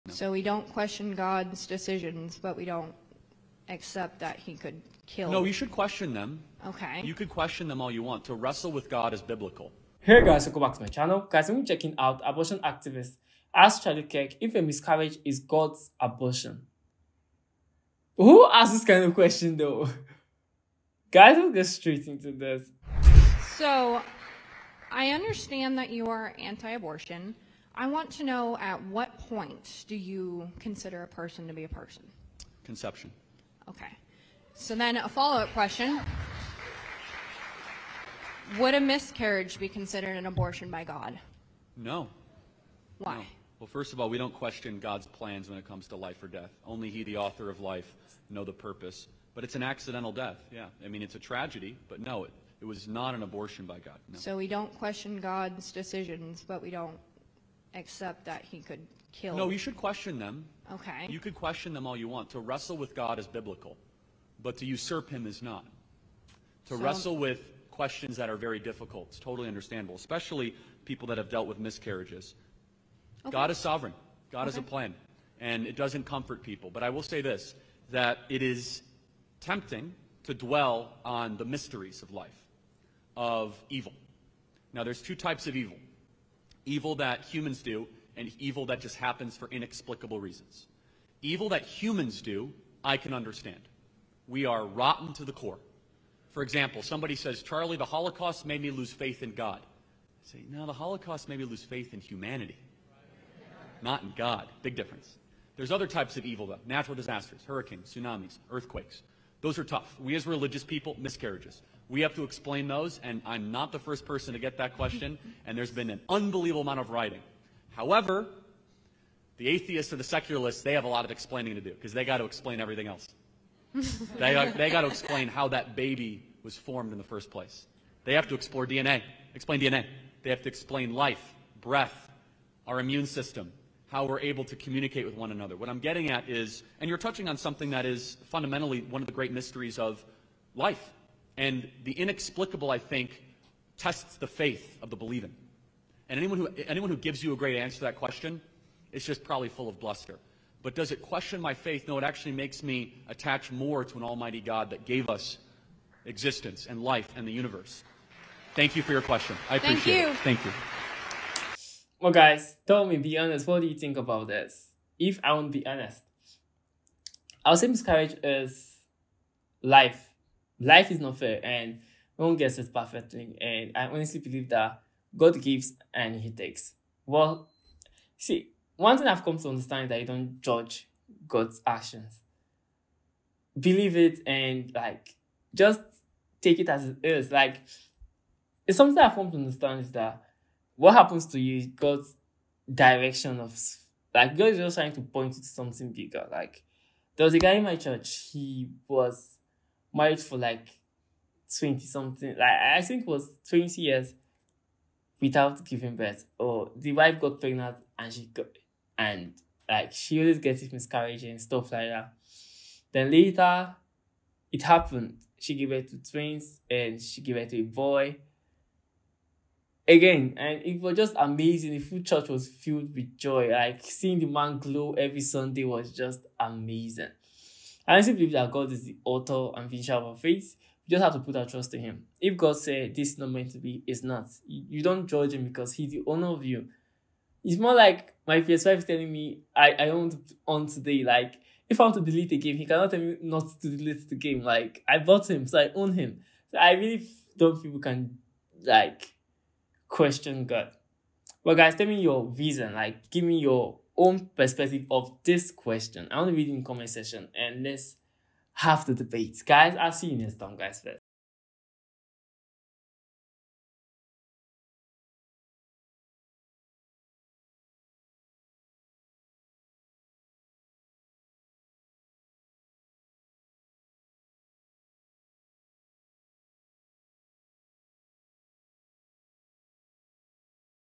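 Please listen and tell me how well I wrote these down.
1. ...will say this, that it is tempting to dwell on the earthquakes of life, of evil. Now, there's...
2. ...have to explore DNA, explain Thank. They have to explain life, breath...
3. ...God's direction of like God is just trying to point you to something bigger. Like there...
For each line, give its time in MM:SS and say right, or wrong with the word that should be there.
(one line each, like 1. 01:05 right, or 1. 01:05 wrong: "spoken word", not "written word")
1. 01:16 wrong: "mysteries", not "earthquakes"
2. 02:08 wrong: "DNA", not "Thank"
3. 03:11 right.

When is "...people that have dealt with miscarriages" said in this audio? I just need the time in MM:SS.
01:10.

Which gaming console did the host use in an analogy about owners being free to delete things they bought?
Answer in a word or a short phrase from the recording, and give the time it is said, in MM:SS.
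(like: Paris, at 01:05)
PS5, at 03:58.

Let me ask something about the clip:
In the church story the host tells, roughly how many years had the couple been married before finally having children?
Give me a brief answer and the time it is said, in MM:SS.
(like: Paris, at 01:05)
20, at 03:23.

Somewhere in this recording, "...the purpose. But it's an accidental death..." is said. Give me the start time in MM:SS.
00:48.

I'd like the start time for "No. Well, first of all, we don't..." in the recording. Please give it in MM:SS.
00:43.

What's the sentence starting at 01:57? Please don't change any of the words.
However, the atheists or the secularists, they have a lot of explaining to do because they got to explain everything else.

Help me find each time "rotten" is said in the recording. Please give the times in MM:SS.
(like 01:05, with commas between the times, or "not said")
01:34.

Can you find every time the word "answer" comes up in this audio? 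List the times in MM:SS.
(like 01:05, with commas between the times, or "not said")
02:27.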